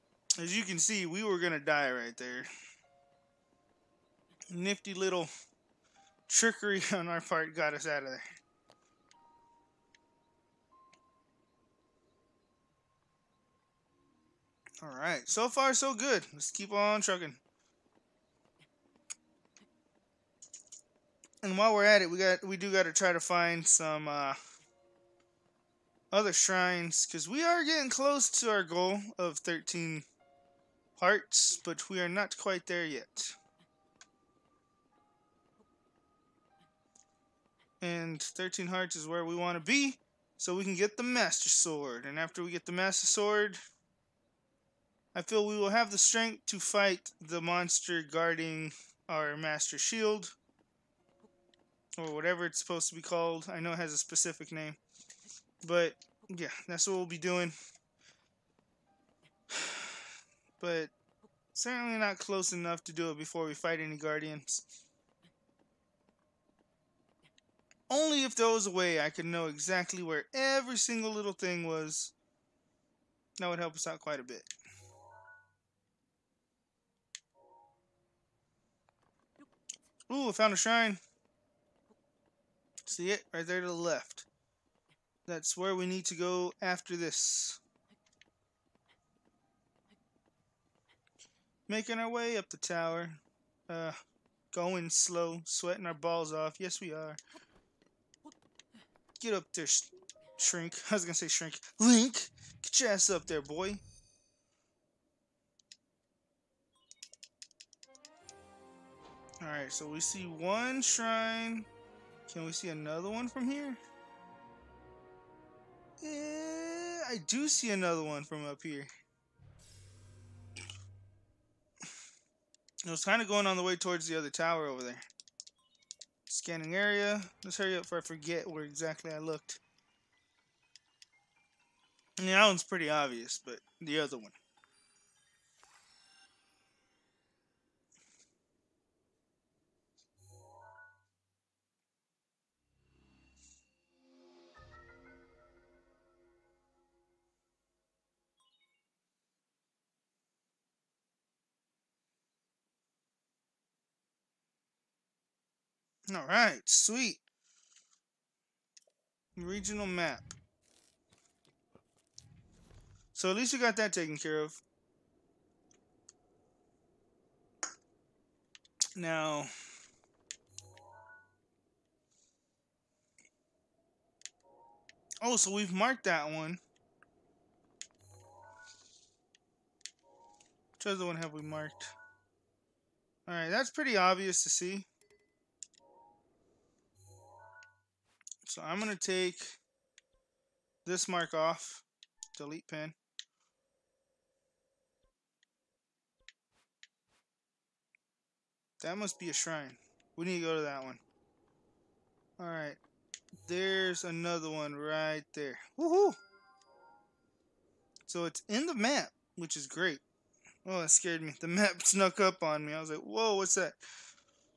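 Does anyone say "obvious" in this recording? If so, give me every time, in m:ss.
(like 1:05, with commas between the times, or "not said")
2:12, 3:03.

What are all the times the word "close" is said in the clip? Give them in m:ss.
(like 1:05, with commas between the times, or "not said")
0:27, 1:02.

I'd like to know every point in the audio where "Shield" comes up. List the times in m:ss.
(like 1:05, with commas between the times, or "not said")
0:49.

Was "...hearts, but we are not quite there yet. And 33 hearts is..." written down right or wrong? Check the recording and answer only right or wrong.
wrong.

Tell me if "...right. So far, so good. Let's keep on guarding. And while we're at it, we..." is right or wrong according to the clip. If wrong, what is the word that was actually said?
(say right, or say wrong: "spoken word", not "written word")
wrong: "trucking", not "guarding".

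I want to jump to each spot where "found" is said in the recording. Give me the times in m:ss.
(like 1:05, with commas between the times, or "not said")
1:20.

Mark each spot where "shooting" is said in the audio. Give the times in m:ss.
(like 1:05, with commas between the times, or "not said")
not said.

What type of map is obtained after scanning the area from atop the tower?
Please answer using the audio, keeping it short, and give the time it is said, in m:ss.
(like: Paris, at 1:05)
Regional map, at 2:39.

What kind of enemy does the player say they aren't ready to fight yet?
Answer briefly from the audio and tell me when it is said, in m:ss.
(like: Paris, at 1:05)
Guardians, at 1:03.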